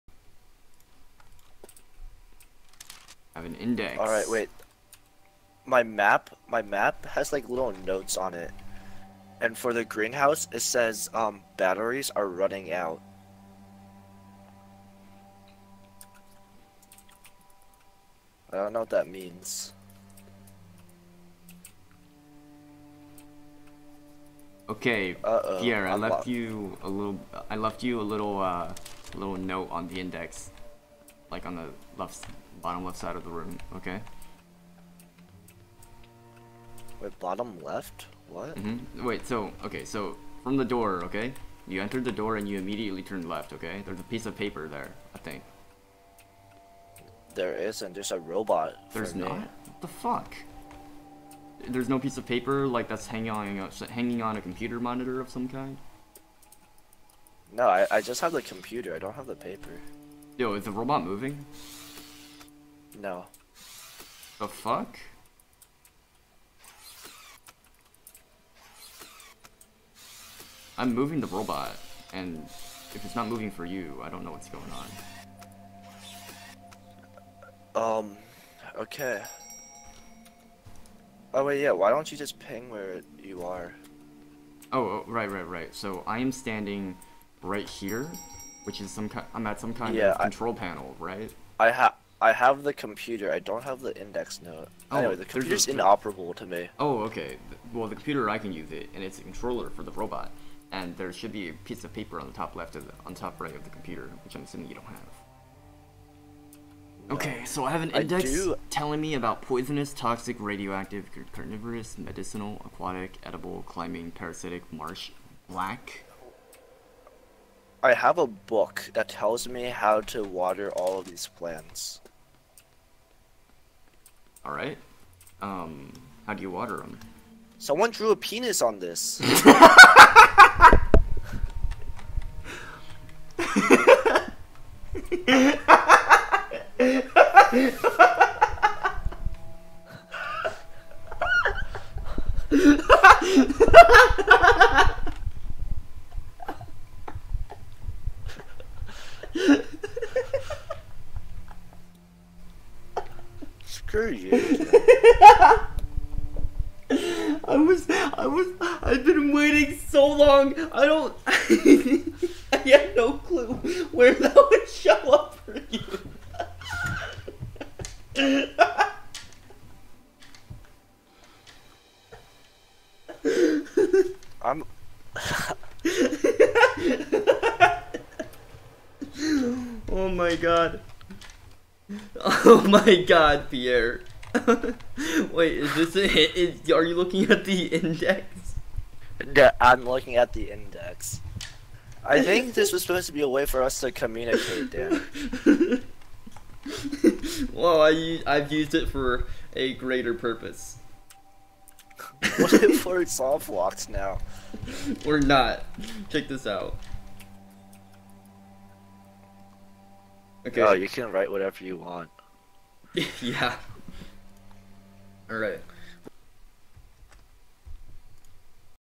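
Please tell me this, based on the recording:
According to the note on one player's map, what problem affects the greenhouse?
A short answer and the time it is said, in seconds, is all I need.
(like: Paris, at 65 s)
Batteries are running out, at 11 s.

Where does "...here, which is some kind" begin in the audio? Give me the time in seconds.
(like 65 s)
87 s.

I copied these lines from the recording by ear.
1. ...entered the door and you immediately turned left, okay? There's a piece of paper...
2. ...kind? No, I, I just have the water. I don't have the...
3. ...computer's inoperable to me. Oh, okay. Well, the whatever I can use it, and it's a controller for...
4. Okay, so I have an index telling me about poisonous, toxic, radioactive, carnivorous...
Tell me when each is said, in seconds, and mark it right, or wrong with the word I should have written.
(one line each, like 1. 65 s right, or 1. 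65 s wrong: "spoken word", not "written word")
1. 41 s right
2. 55 s wrong: "computer", not "water"
3. 95 s wrong: "computer", not "whatever"
4. 107 s right.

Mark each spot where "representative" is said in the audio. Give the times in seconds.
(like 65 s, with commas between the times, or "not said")
not said.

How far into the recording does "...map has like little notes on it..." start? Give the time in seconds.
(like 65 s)
6 s.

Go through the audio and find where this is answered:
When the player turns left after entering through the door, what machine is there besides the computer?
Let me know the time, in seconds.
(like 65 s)
48 s.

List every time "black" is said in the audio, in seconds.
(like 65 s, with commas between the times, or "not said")
115 s.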